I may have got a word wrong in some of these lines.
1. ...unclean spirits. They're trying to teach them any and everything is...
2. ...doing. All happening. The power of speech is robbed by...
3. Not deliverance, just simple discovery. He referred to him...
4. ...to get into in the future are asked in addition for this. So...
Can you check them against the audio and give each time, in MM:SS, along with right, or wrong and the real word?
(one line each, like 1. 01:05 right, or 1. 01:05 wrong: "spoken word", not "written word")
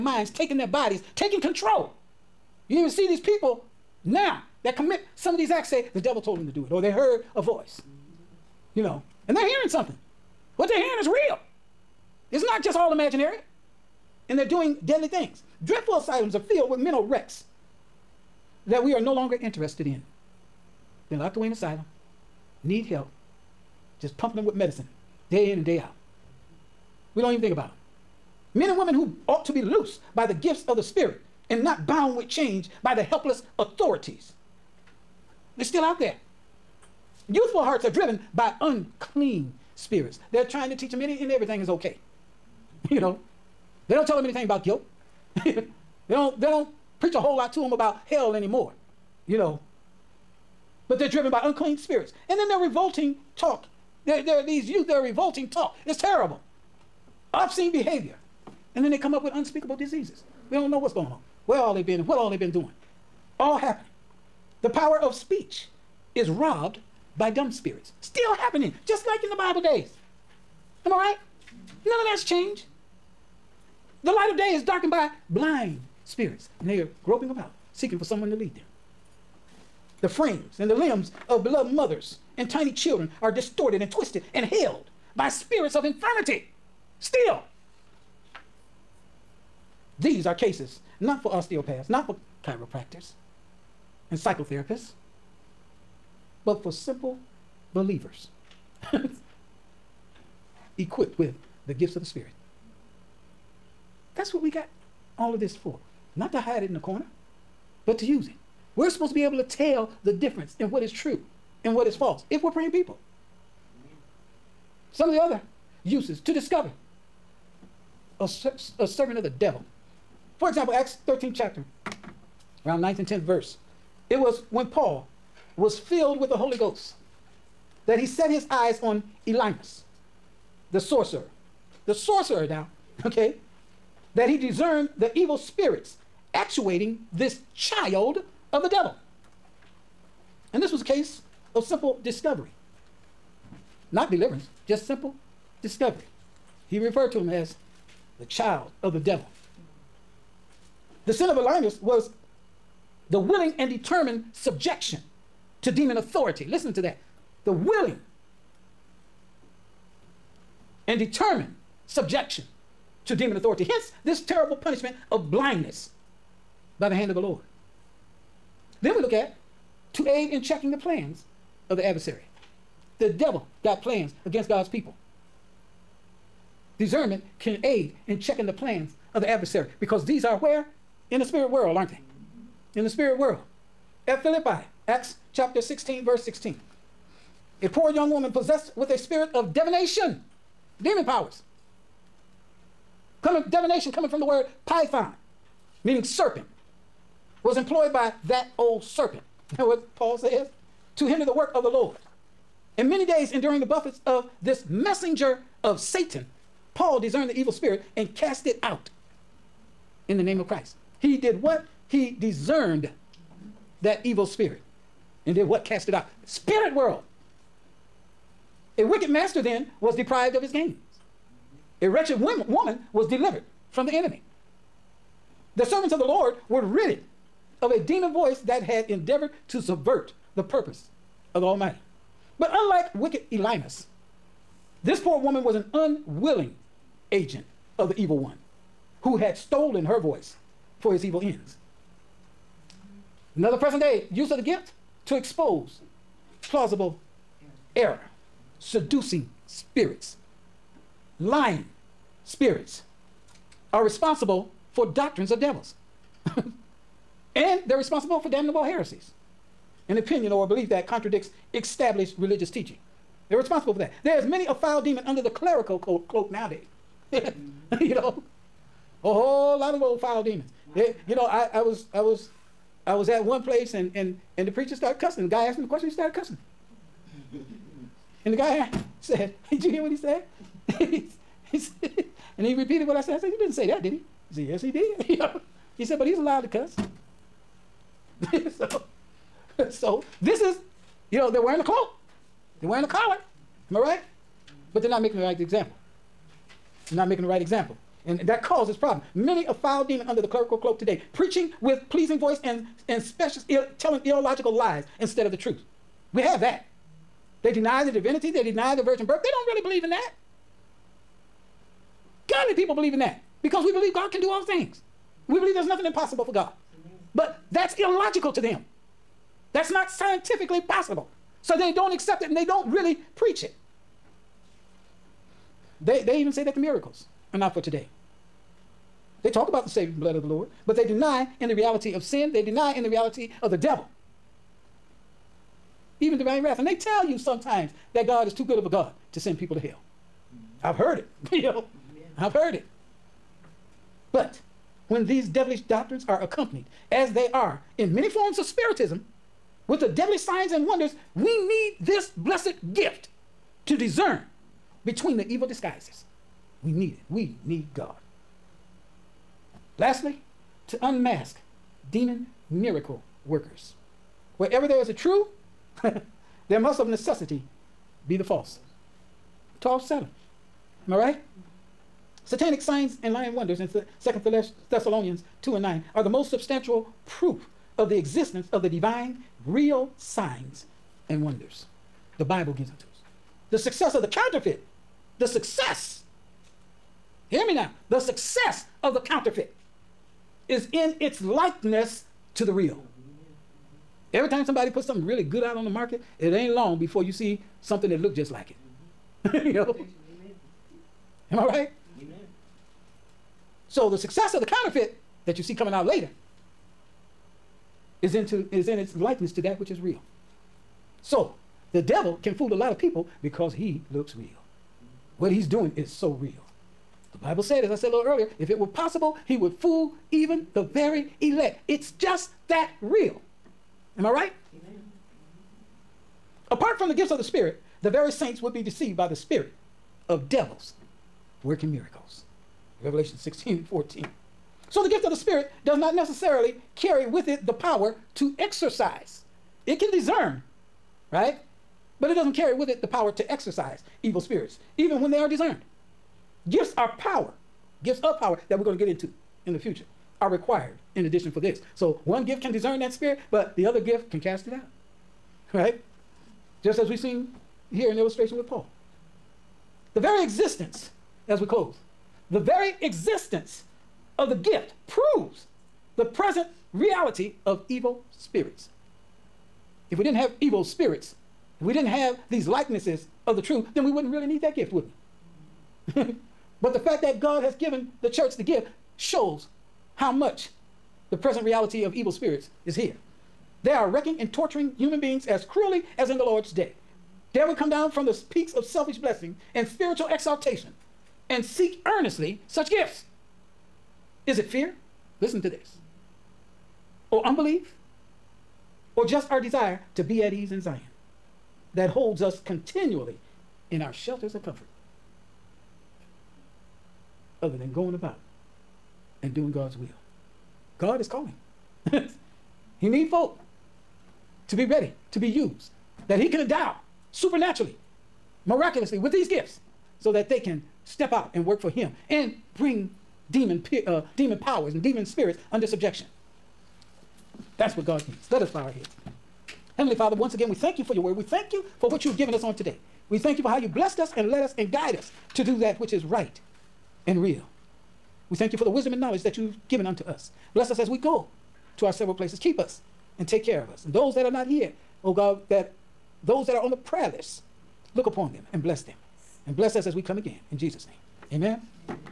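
1. 00:38 right
2. 01:02 right
3. 02:23 right
4. 07:28 wrong: "required", not "asked".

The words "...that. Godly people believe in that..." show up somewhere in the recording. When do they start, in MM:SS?
05:09.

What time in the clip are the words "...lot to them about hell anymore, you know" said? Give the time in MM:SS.
00:47.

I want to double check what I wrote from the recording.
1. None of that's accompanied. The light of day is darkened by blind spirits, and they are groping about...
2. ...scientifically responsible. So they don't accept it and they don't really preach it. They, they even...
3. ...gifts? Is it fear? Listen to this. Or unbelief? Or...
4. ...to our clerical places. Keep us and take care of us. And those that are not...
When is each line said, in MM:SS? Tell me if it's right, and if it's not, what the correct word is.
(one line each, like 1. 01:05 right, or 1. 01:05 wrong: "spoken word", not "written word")
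1. 01:11 wrong: "changed", not "accompanied"
2. 05:19 wrong: "possible", not "responsible"
3. 08:12 right
4. 09:01 wrong: "several", not "clerical".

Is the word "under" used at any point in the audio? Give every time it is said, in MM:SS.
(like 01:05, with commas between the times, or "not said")
04:25, 05:00, 08:45.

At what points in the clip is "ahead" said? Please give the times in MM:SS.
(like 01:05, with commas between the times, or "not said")
not said.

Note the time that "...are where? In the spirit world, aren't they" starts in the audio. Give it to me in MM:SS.
03:00.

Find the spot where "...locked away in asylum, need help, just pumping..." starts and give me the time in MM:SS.
00:21.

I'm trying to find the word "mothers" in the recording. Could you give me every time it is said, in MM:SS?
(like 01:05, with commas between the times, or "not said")
01:21.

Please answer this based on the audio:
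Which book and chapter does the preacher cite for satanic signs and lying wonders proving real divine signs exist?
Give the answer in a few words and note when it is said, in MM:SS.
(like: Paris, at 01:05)
Second Thessalonians 2, at 06:13.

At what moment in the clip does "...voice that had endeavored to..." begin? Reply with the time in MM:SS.
03:48.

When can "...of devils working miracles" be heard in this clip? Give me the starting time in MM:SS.
07:10.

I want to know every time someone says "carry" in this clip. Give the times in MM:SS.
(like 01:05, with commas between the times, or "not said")
07:16, 07:22.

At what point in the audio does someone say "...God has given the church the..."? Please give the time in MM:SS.
07:57.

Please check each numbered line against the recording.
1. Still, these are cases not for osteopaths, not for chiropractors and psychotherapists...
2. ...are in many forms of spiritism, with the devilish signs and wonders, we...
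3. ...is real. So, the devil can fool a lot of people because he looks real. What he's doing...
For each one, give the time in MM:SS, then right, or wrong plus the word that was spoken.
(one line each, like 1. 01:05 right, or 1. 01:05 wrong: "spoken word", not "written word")
1. 01:27 right
2. 05:47 right
3. 06:49 right.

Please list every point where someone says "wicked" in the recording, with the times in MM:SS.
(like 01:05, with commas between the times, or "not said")
03:38, 03:52.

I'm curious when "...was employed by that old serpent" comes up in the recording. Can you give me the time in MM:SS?
03:17.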